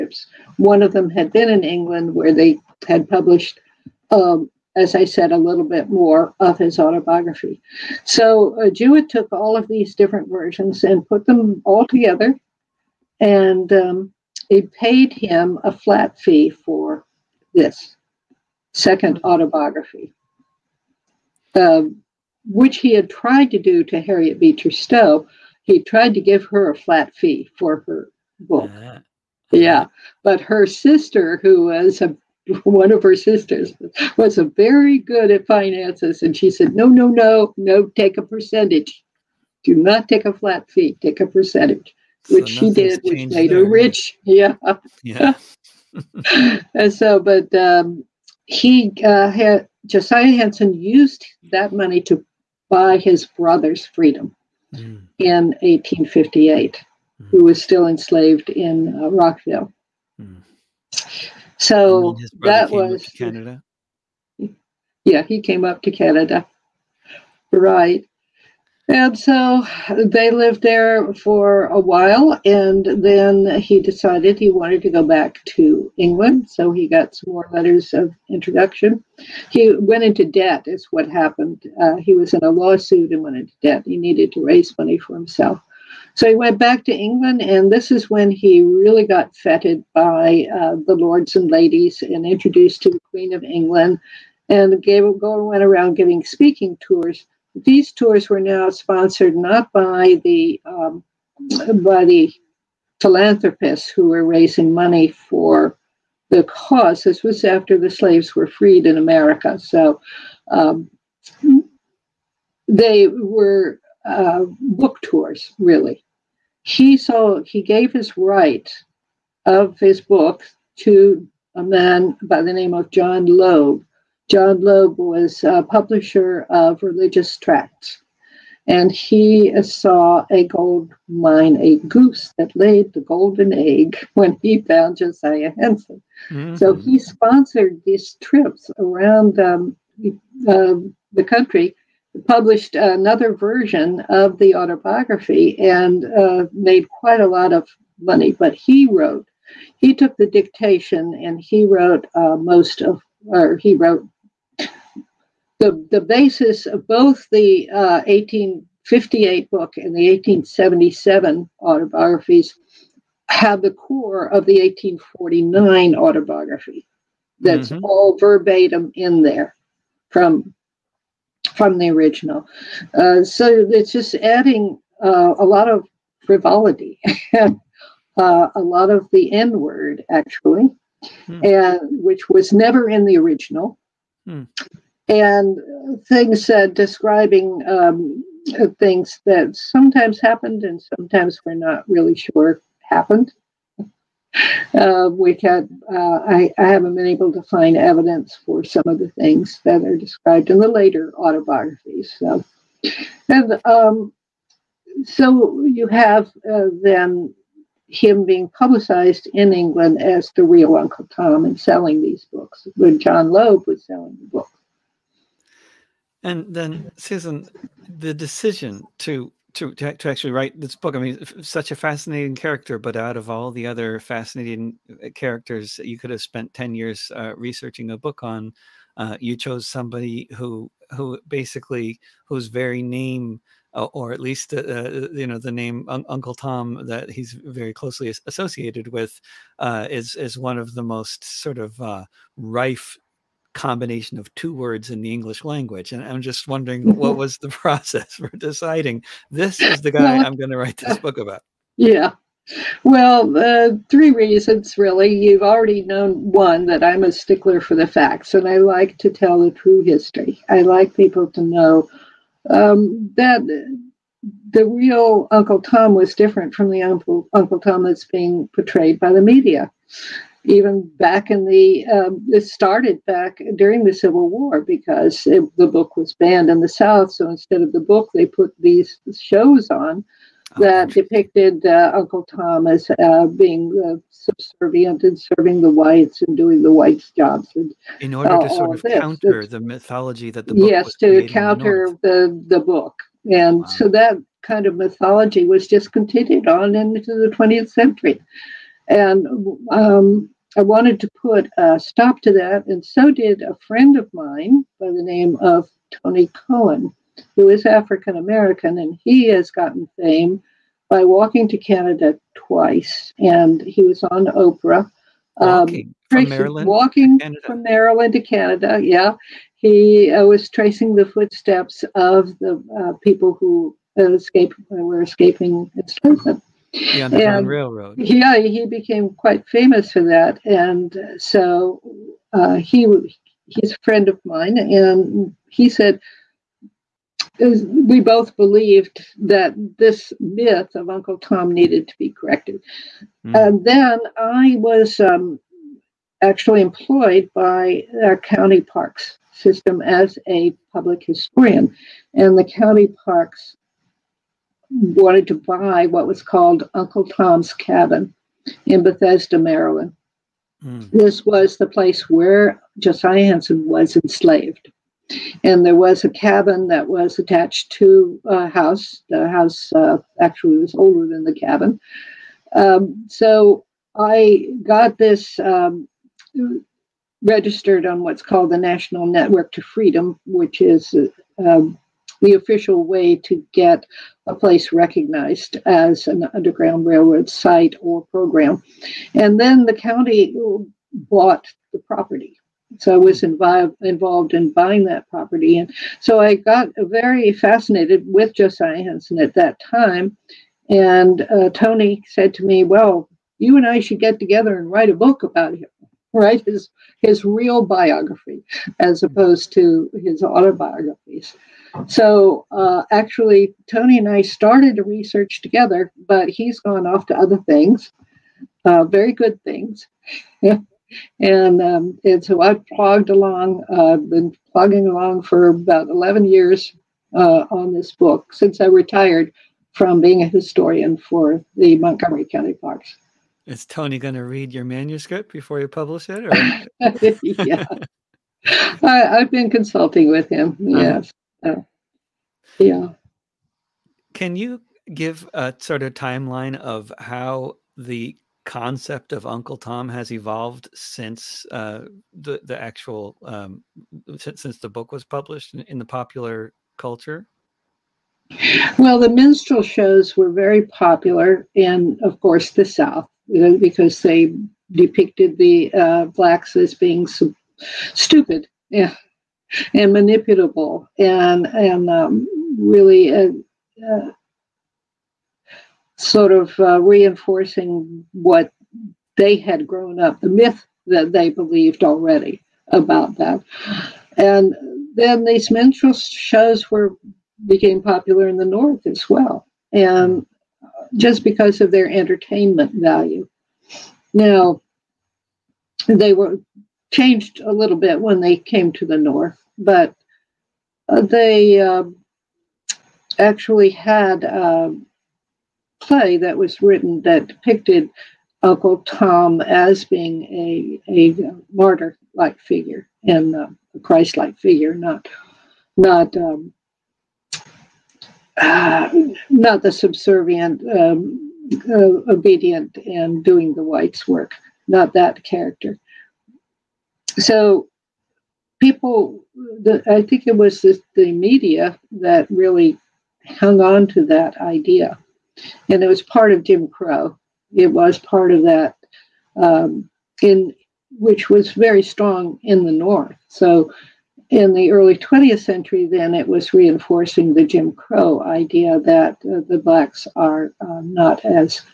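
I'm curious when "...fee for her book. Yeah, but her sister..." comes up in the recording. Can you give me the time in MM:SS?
00:27.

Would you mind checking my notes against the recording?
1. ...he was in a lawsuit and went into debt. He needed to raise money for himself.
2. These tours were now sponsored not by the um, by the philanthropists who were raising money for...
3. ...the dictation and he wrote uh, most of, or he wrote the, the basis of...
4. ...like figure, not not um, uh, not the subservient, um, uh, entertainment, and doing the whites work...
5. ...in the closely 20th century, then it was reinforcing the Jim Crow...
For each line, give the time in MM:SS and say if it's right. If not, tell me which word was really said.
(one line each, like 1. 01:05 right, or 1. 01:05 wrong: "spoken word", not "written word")
1. 01:21 right
2. 01:37 right
3. 02:30 right
4. 08:34 wrong: "obedient", not "entertainment"
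5. 09:04 wrong: "early", not "closely".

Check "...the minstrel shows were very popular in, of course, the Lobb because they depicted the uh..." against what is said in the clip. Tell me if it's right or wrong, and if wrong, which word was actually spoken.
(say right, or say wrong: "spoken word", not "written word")
wrong: "South", not "Lobb".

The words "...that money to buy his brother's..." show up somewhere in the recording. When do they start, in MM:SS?
00:51.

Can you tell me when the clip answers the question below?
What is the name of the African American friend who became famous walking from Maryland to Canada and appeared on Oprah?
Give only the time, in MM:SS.
05:05.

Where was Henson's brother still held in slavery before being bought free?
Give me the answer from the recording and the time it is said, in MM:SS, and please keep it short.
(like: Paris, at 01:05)
Rockville, at 00:59.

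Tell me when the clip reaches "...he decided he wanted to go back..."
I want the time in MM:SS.
01:13.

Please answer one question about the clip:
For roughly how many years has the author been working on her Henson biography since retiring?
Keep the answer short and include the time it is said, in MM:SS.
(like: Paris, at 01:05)
11, at 07:05.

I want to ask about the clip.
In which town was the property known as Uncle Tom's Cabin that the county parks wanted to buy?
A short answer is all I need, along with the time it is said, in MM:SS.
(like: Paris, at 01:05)
Bethesda, Maryland, at 05:58.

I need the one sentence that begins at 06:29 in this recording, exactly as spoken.
And then the county bought the property.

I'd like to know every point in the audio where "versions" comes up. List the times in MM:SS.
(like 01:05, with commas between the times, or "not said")
00:10, 02:23.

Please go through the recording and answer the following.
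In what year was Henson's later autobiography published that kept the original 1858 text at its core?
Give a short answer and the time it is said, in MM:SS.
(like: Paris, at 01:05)
1877, at 02:40.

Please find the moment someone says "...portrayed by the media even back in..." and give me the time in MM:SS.
04:28.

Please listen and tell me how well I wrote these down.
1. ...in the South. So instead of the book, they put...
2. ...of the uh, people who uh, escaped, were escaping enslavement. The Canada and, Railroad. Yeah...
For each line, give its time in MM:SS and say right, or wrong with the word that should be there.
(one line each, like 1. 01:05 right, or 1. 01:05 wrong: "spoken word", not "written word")
1. 04:36 right
2. 05:21 wrong: "Underground", not "Canada".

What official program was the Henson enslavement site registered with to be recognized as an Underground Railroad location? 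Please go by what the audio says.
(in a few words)
National Network to Freedom.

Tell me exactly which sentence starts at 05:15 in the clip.
Um, walking um, tracing, from Maryland, walking from Maryland to Canada.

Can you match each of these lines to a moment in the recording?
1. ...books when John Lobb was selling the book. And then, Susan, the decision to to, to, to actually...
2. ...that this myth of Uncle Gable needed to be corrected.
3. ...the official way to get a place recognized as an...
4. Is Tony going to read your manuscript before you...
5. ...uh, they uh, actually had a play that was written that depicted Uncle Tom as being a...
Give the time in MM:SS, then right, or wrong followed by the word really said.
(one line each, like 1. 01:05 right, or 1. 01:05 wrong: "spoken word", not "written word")
1. 03:32 right
2. 05:39 wrong: "Tom", not "Gable"
3. 06:22 right
4. 07:13 right
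5. 08:20 right.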